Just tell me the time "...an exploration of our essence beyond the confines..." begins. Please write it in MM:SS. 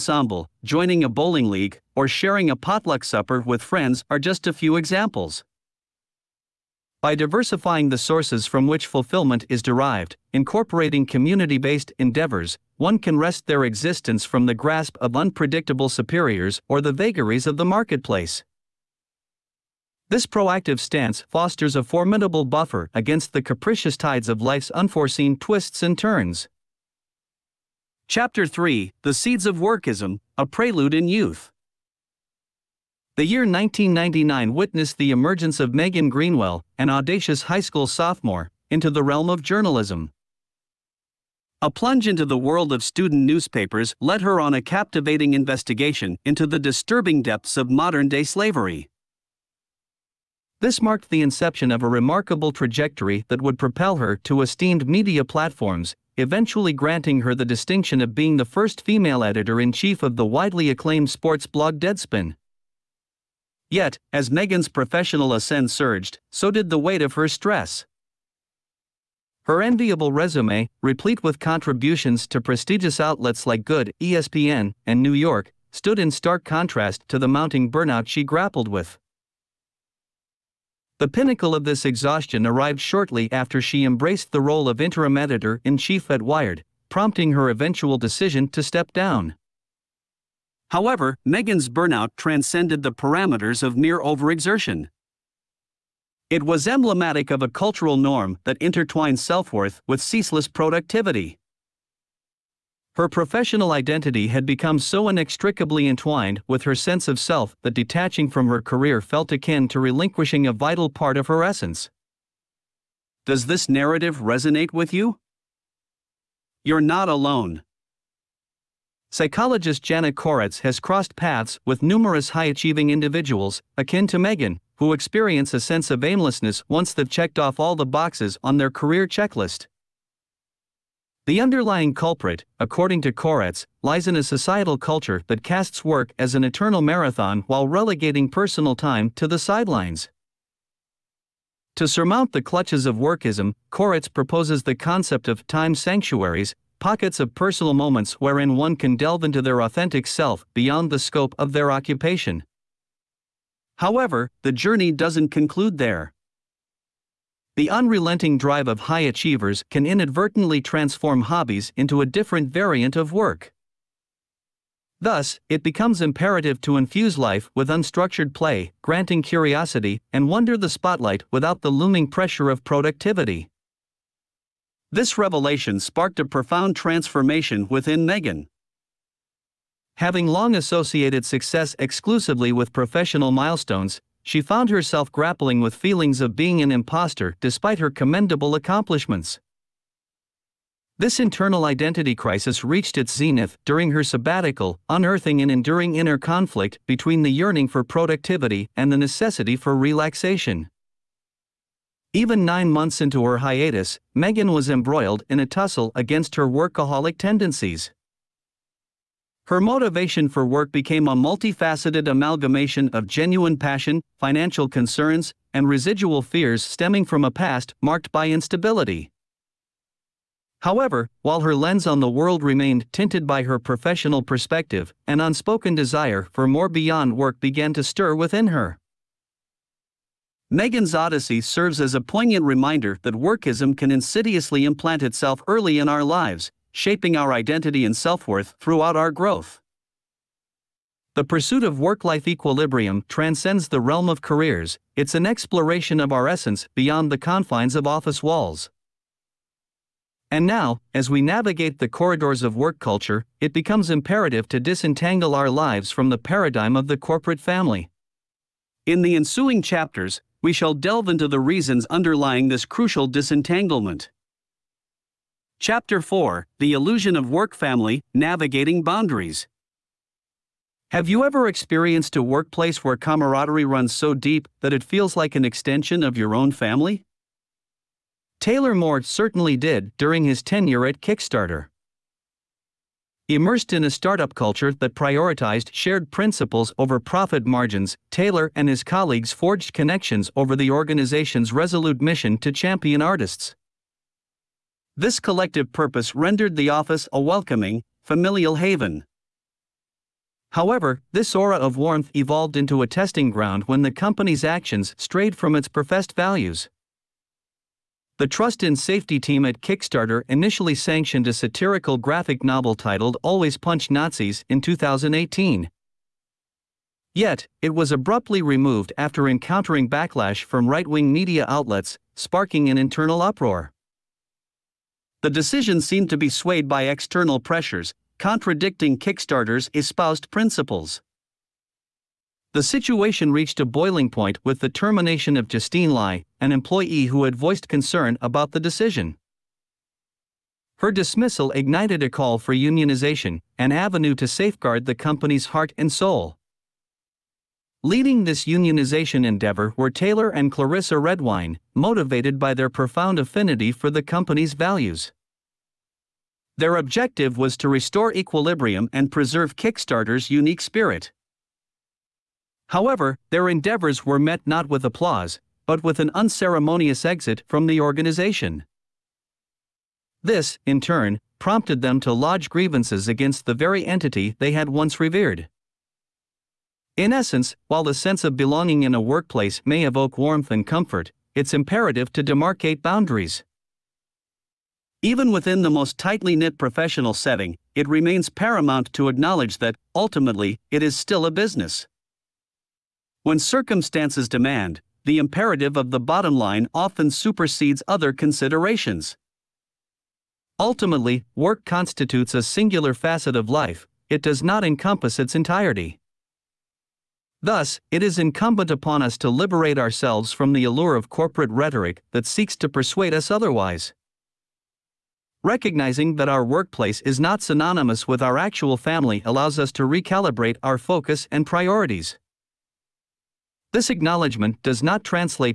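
04:05.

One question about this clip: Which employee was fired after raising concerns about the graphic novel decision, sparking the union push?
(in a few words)
Justine Lai.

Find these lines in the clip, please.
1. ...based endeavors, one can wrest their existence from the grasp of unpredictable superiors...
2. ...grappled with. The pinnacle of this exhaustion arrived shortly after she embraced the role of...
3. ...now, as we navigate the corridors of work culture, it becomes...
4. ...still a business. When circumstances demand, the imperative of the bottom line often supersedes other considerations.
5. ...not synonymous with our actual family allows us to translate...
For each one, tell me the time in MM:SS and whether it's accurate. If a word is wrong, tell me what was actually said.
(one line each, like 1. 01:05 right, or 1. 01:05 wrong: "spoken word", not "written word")
1. 00:11 right
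2. 01:18 right
3. 04:10 right
4. 06:30 right
5. 06:57 wrong: "recalibrate", not "translate".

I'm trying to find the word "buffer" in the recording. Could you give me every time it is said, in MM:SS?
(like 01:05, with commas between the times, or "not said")
00:22.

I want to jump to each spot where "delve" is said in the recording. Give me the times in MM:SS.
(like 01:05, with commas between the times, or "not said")
02:28, 04:20.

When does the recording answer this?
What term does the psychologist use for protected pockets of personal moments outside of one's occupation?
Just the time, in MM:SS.
02:25.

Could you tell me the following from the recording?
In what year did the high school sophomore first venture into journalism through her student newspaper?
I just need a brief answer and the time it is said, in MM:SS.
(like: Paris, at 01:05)
1999, at 00:33.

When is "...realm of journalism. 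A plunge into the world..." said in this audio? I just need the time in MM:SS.
00:39.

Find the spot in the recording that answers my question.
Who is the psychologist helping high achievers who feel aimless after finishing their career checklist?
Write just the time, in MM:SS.
01:59.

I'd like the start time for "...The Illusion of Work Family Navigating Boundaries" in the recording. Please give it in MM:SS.
04:26.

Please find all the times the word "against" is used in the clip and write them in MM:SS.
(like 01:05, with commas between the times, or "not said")
00:22, 03:25, 06:13.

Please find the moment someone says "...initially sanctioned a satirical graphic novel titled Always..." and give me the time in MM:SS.
05:10.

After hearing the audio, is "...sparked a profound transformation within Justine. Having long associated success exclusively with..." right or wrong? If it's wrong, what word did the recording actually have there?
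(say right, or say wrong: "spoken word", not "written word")
wrong: "Megan", not "Justine".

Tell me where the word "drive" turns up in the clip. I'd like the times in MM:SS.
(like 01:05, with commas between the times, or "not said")
02:38.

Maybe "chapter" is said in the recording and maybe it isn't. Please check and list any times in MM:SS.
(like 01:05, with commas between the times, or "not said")
00:28, 04:19, 04:25.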